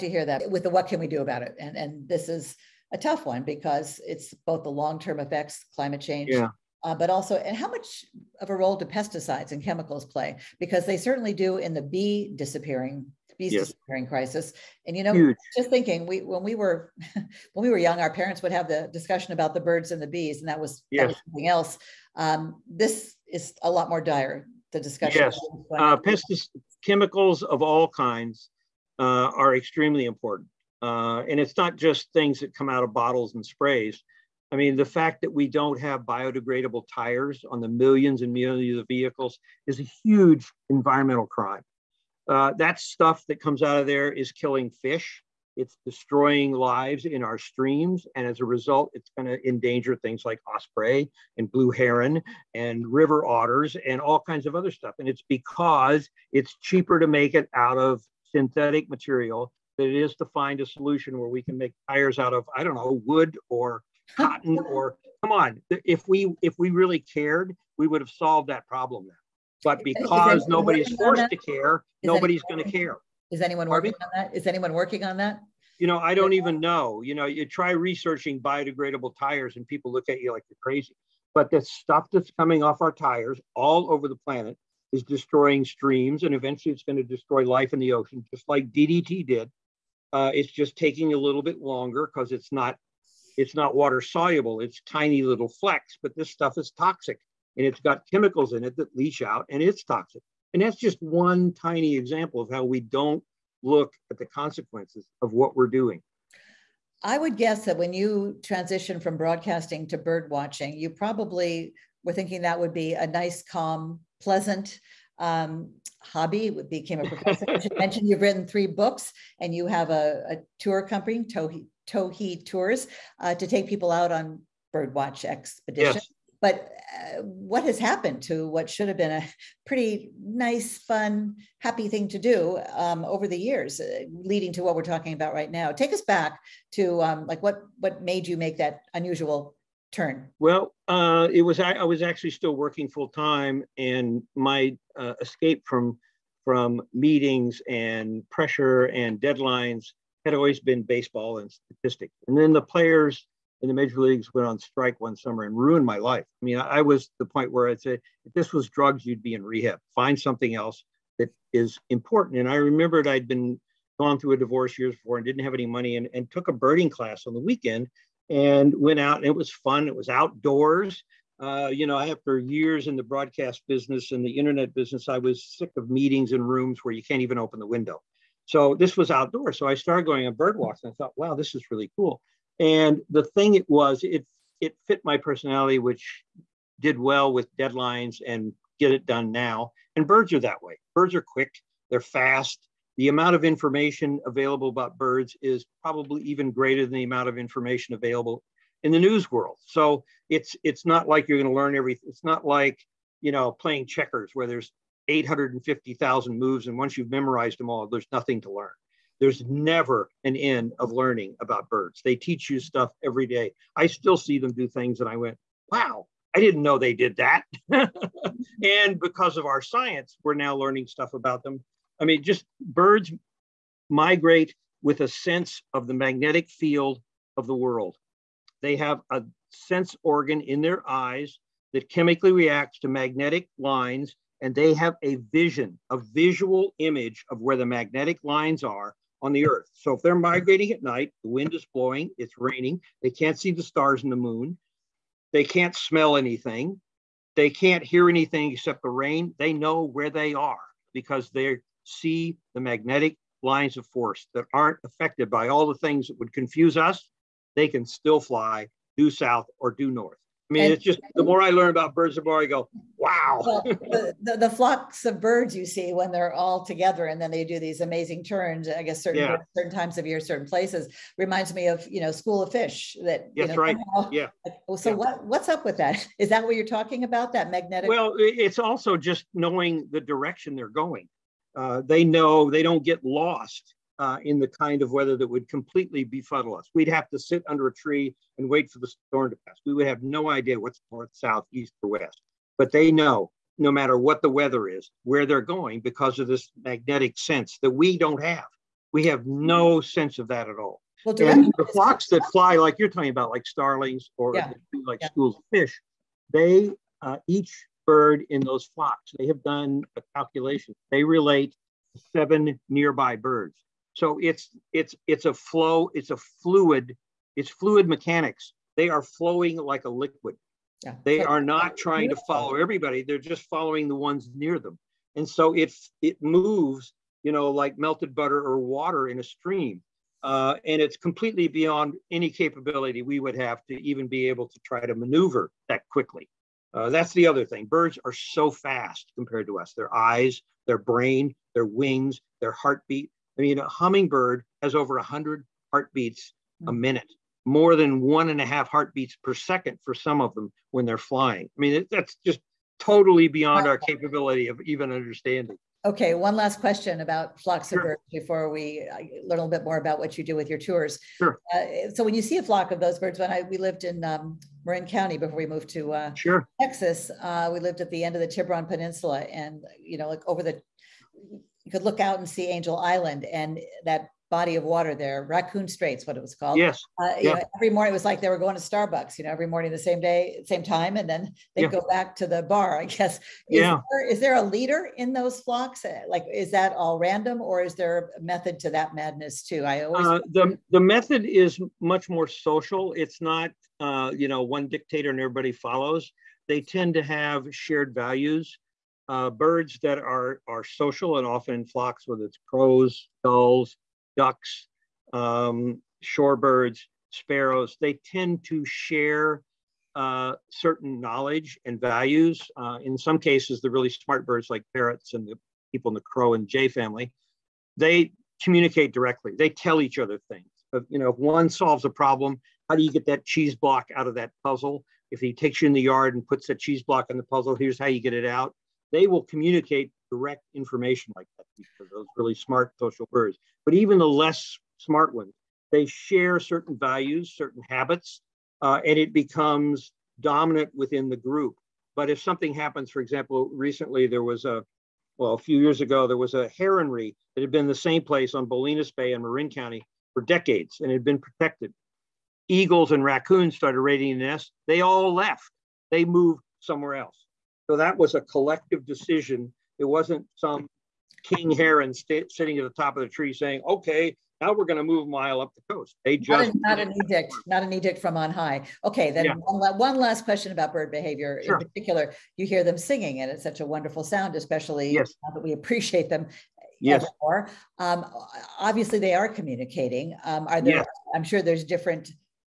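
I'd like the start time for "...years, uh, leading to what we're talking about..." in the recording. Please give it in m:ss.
2:13.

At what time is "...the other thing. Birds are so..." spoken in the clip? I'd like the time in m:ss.
5:37.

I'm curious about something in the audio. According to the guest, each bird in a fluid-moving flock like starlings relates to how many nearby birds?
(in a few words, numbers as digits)
7.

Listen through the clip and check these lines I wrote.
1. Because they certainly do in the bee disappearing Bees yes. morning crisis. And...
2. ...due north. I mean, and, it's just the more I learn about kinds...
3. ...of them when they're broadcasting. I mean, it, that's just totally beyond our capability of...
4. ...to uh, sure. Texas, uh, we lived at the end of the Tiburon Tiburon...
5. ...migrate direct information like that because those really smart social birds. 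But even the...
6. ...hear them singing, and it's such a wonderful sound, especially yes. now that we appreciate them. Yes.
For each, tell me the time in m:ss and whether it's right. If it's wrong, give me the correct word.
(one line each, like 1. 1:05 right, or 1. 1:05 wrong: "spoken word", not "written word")
1. 0:10 wrong: "disappearing", not "morning"
2. 4:19 wrong: "birds", not "kinds"
3. 5:50 wrong: "flying", not "broadcasting"
4. 6:05 wrong: "Peninsula", not "Tiburon"
5. 7:09 wrong: "communicate", not "migrate"
6. 7:52 right.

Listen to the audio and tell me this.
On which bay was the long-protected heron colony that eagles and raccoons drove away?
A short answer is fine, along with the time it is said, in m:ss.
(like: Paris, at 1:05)
Bolinas Bay, at 7:28.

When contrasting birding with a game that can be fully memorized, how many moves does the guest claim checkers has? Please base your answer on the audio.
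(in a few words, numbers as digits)
850,000.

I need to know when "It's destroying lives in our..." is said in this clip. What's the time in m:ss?
0:45.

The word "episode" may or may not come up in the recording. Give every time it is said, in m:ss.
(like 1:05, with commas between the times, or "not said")
not said.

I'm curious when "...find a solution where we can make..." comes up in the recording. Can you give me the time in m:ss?
1:00.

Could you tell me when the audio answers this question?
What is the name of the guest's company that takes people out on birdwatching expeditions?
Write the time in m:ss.
2:01.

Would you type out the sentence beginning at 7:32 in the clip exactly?
Eagles and raccoons started raiding the nest.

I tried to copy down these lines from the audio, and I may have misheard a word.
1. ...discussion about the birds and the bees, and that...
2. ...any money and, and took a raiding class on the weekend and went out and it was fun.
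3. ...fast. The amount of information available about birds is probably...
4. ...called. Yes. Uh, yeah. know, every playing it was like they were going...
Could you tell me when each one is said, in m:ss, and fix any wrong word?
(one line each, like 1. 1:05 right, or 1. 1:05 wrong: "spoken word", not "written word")
1. 0:18 right
2. 2:45 wrong: "birding", not "raiding"
3. 3:11 right
4. 6:16 wrong: "morning", not "playing".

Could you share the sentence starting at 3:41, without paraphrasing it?
I mean, just birds migrate with a sense of the magnetic field of the world.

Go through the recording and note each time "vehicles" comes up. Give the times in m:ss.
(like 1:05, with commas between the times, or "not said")
0:38.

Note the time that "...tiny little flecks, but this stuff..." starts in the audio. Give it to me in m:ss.
1:34.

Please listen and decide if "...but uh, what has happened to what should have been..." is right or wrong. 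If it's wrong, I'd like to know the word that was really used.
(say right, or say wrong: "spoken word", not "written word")
right.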